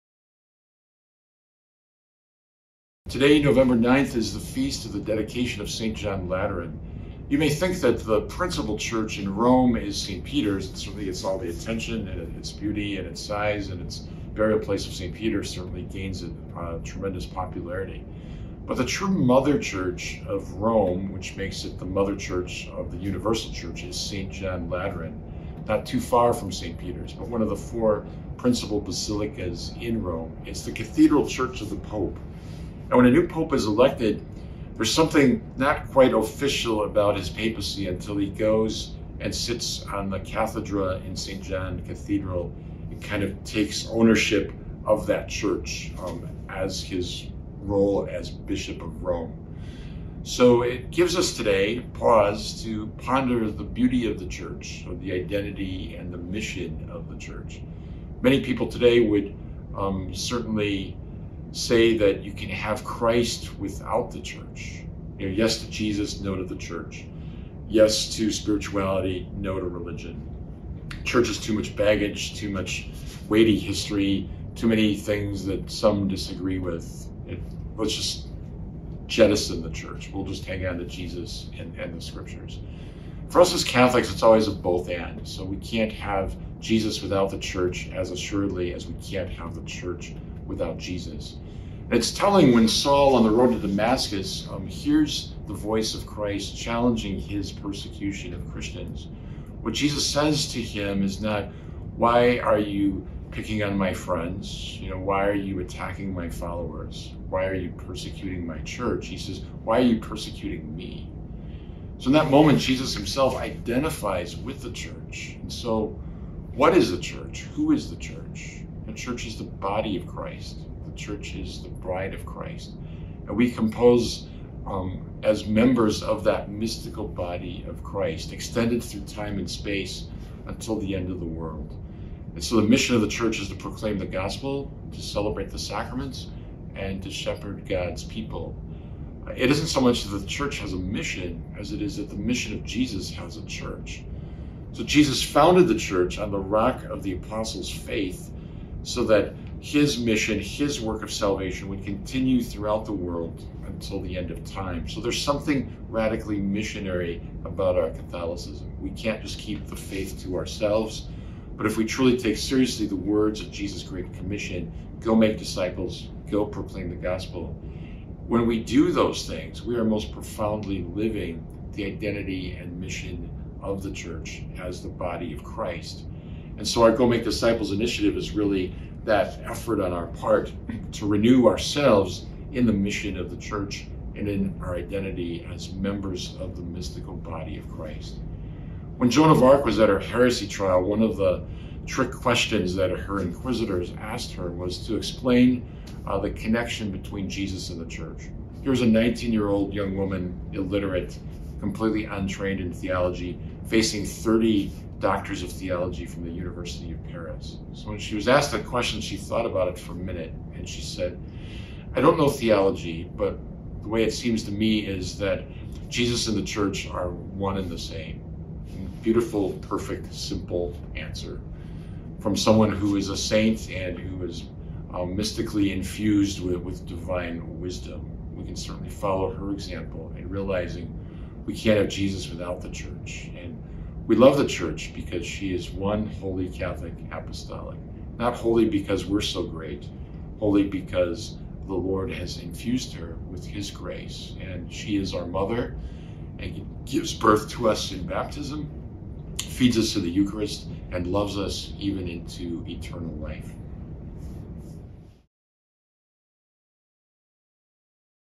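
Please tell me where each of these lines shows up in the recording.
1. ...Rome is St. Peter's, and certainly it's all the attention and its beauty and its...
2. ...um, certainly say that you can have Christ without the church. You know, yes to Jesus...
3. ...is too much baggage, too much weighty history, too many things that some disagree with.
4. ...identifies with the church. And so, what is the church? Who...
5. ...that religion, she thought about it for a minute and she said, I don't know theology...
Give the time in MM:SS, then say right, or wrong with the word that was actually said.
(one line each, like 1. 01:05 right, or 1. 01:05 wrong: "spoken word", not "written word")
1. 00:09 right
2. 00:59 right
3. 01:11 right
4. 01:53 right
5. 03:28 wrong: "question", not "religion".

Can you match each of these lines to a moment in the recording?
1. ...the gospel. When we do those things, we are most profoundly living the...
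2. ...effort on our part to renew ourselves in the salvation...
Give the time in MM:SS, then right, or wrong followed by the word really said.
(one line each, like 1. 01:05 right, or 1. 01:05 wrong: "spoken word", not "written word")
1. 02:46 right
2. 02:59 wrong: "mission", not "salvation".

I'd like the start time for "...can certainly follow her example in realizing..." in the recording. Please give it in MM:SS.
03:48.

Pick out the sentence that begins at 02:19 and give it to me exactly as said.
It isn't so much that the church has a mission as it is that the mission of Jesus has a church.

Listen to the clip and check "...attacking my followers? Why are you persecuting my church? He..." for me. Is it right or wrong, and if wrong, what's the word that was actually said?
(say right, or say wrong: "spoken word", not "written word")
right.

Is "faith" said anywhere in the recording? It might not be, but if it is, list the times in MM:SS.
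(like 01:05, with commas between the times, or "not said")
02:27, 02:39.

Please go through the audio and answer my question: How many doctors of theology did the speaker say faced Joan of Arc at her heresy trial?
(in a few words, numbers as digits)
30.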